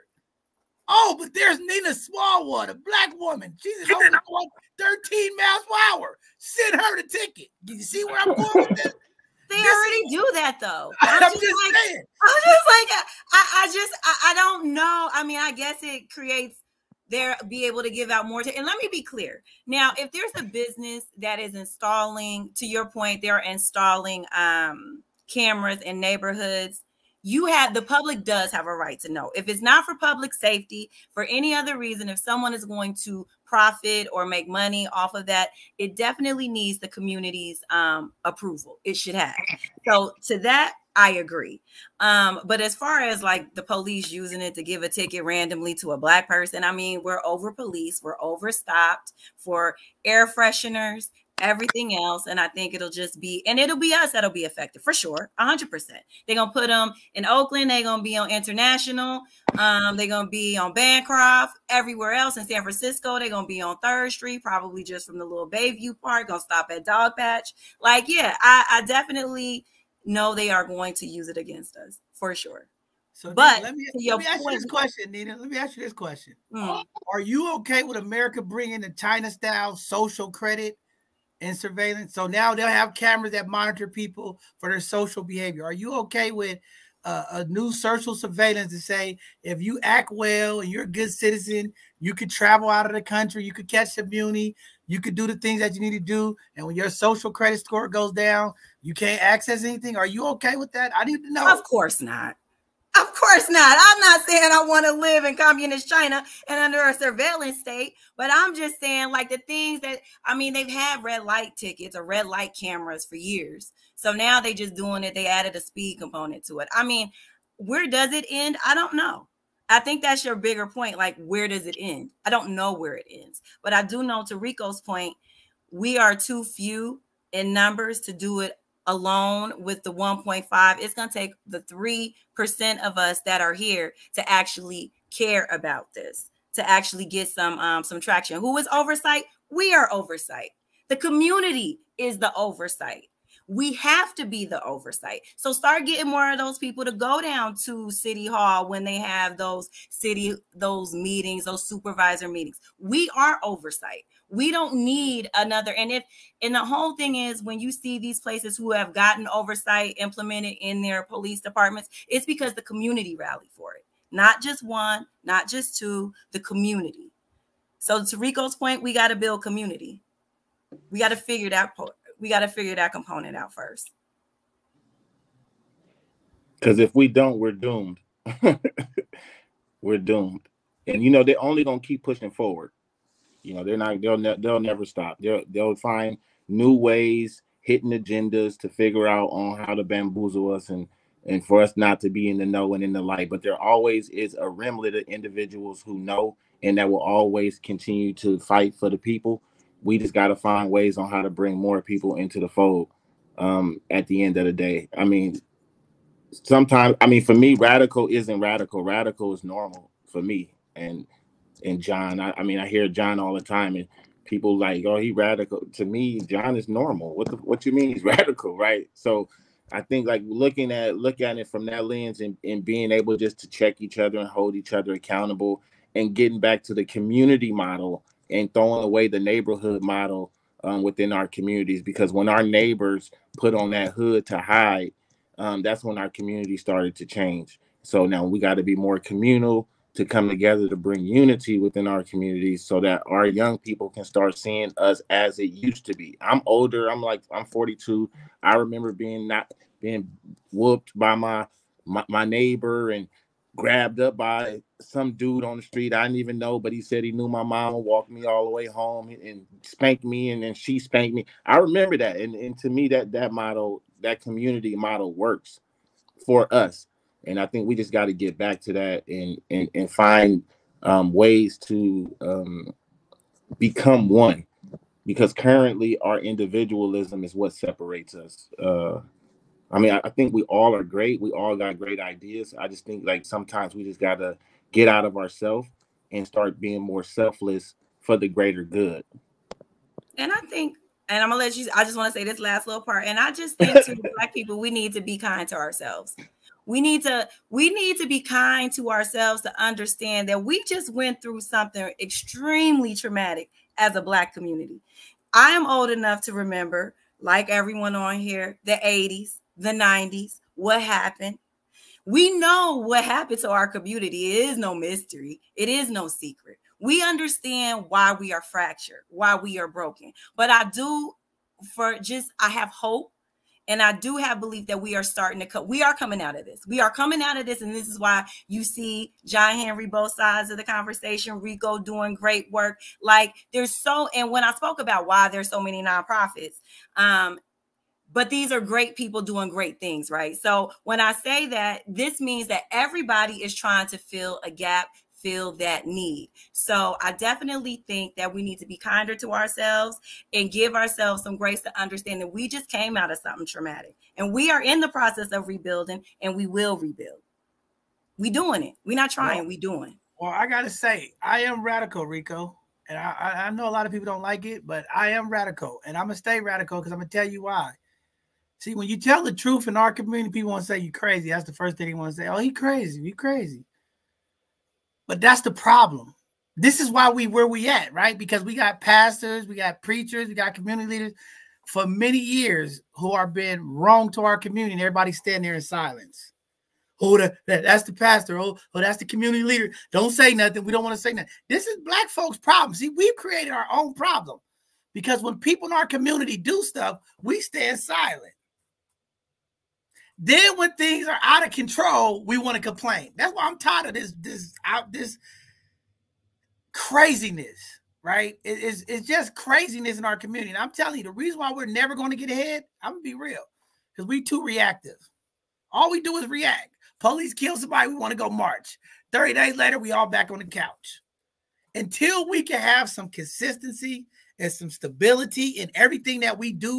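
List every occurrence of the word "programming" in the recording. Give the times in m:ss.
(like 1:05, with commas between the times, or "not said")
not said.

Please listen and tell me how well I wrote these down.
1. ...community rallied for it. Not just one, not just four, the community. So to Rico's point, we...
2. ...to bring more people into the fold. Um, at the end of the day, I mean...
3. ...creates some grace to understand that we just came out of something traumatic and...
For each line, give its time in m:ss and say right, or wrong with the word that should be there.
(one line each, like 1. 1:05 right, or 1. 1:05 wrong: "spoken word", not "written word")
1. 2:42 wrong: "two", not "four"
2. 3:21 right
3. 5:50 wrong: "ourselves", not "creates".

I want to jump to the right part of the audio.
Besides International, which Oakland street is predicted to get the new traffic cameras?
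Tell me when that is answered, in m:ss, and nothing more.
1:00.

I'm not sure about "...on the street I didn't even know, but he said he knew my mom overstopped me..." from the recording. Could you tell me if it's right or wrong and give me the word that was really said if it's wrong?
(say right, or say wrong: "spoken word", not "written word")
wrong: "walked", not "overstopped".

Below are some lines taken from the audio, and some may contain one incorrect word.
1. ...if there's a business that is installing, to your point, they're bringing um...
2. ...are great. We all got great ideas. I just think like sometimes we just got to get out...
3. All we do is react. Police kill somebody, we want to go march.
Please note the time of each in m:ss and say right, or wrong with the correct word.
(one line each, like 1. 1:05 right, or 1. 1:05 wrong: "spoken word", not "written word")
1. 0:19 wrong: "installing", not "bringing"
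2. 4:40 right
3. 6:55 right.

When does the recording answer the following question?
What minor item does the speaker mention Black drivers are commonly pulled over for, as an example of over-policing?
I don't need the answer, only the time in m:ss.
0:50.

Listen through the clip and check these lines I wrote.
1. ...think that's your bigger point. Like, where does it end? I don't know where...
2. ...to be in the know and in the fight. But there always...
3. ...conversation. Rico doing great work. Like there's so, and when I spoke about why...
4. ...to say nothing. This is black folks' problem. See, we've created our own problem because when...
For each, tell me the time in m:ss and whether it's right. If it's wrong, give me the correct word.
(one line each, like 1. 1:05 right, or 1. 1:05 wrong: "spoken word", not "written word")
1. 1:59 right
2. 3:12 wrong: "light", not "fight"
3. 5:30 right
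4. 6:30 right.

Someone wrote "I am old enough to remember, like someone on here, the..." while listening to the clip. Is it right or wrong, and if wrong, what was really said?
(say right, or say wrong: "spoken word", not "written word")
wrong: "everyone", not "someone".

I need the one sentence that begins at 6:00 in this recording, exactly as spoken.
Well, I gotta say, I am radical, Rico.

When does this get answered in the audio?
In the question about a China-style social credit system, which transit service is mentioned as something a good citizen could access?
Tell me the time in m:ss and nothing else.
1:34.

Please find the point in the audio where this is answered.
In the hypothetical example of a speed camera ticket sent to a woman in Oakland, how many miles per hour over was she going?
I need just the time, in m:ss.
0:04.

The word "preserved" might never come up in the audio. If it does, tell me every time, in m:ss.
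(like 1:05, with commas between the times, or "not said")
not said.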